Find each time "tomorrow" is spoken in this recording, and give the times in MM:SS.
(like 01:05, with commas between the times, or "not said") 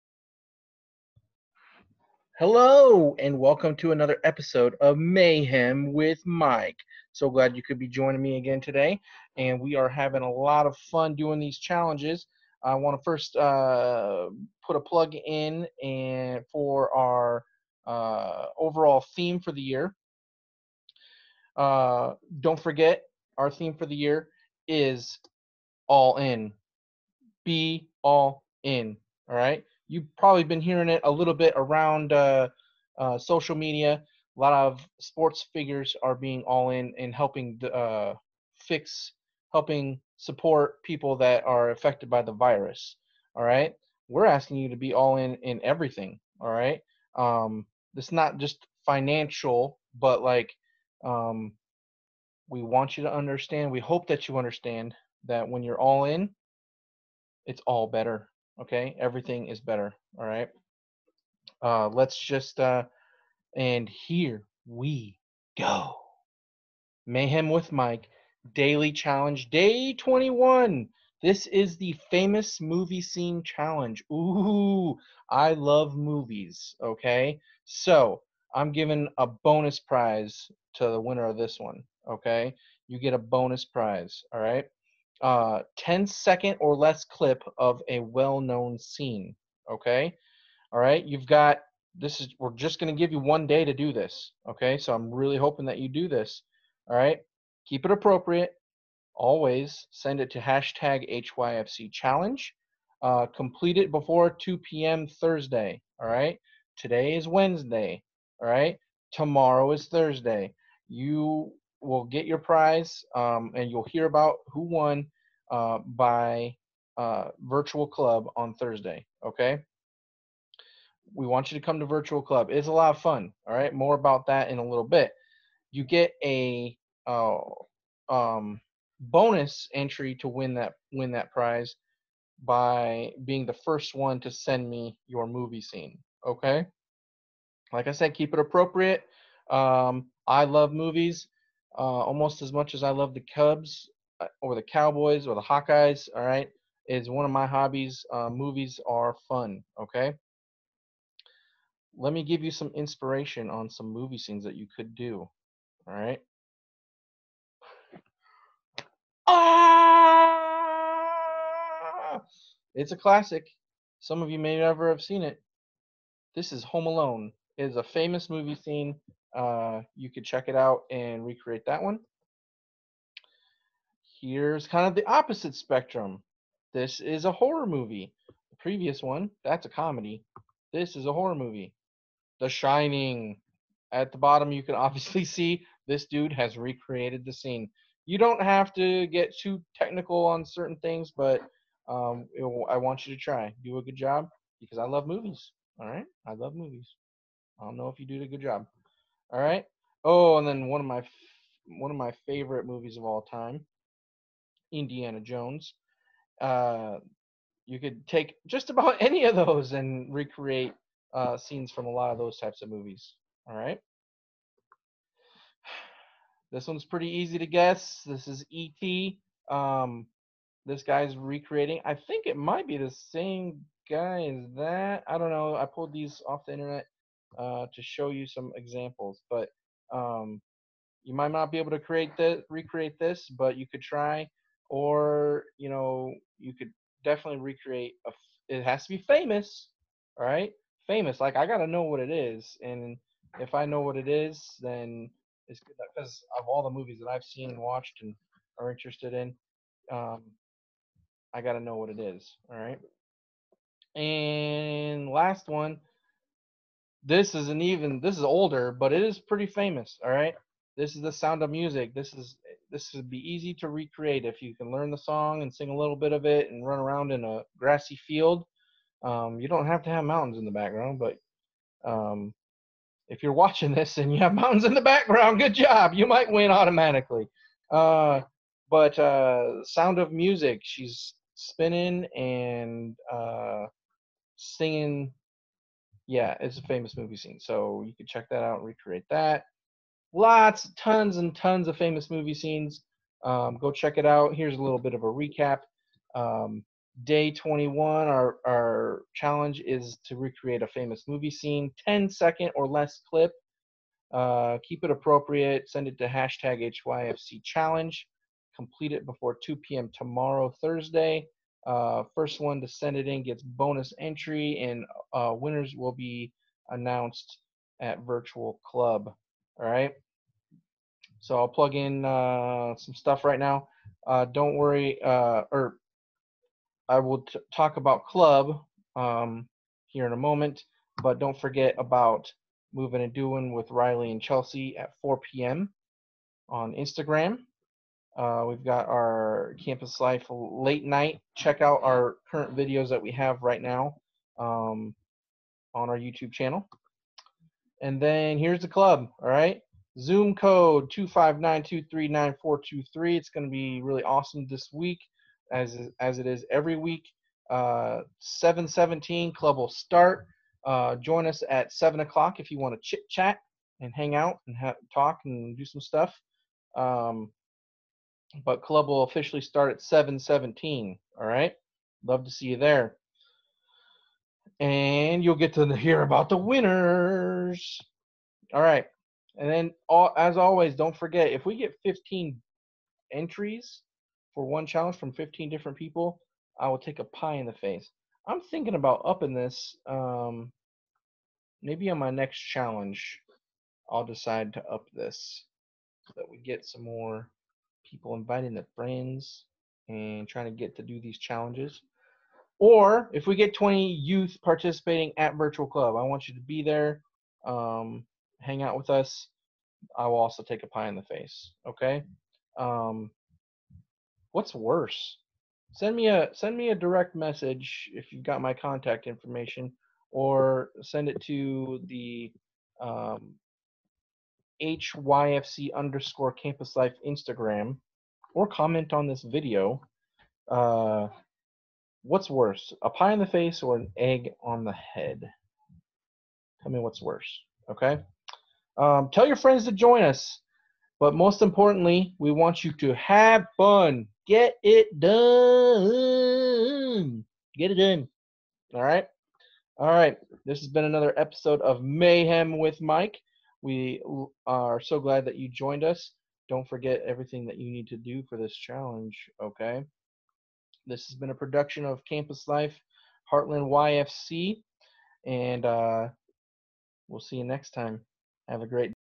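01:49, 05:09.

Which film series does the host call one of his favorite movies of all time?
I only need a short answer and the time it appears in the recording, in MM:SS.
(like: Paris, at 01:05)
Indiana Jones, at 03:24.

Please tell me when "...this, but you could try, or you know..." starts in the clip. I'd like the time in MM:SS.
03:52.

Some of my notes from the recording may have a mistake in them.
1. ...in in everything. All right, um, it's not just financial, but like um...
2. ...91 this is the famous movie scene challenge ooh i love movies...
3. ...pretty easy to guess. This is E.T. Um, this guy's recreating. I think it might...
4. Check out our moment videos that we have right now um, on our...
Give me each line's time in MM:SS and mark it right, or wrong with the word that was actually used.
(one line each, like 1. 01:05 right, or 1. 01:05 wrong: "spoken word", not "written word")
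1. 00:45 right
2. 01:09 wrong: "21", not "91"
3. 03:36 right
4. 05:41 wrong: "current", not "moment".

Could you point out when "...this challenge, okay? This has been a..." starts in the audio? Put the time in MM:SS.
07:38.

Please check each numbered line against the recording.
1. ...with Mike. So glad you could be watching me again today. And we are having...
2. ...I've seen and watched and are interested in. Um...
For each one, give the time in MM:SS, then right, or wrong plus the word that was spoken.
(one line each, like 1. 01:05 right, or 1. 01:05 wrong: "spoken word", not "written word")
1. 00:05 wrong: "joining", not "watching"
2. 04:07 right.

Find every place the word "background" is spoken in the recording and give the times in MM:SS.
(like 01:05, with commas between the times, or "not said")
04:30, 04:34.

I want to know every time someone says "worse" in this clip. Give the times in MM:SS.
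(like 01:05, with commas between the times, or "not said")
06:54, 07:12, 07:17.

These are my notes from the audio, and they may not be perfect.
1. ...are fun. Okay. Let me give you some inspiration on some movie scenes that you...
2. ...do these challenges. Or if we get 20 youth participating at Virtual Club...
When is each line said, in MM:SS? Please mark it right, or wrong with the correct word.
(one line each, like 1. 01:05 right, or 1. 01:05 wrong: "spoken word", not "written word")
1. 02:28 right
2. 06:40 right.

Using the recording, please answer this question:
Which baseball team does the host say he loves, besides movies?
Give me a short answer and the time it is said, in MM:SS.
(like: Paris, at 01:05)
Cubs, at 02:23.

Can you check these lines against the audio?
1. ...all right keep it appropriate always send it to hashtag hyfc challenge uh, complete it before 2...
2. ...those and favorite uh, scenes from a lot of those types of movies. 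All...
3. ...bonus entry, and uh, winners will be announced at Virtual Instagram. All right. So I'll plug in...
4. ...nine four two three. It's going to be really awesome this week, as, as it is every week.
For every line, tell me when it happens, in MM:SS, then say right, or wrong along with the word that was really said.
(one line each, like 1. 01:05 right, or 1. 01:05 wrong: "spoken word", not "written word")
1. 01:36 right
2. 03:29 wrong: "recreate", not "favorite"
3. 05:13 wrong: "Club", not "Instagram"
4. 05:52 right.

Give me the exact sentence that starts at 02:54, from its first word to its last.
Here's kind of the opposite spectrum.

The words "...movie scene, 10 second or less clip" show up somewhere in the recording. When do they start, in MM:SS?
05:01.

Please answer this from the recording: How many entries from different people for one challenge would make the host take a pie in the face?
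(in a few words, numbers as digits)
15.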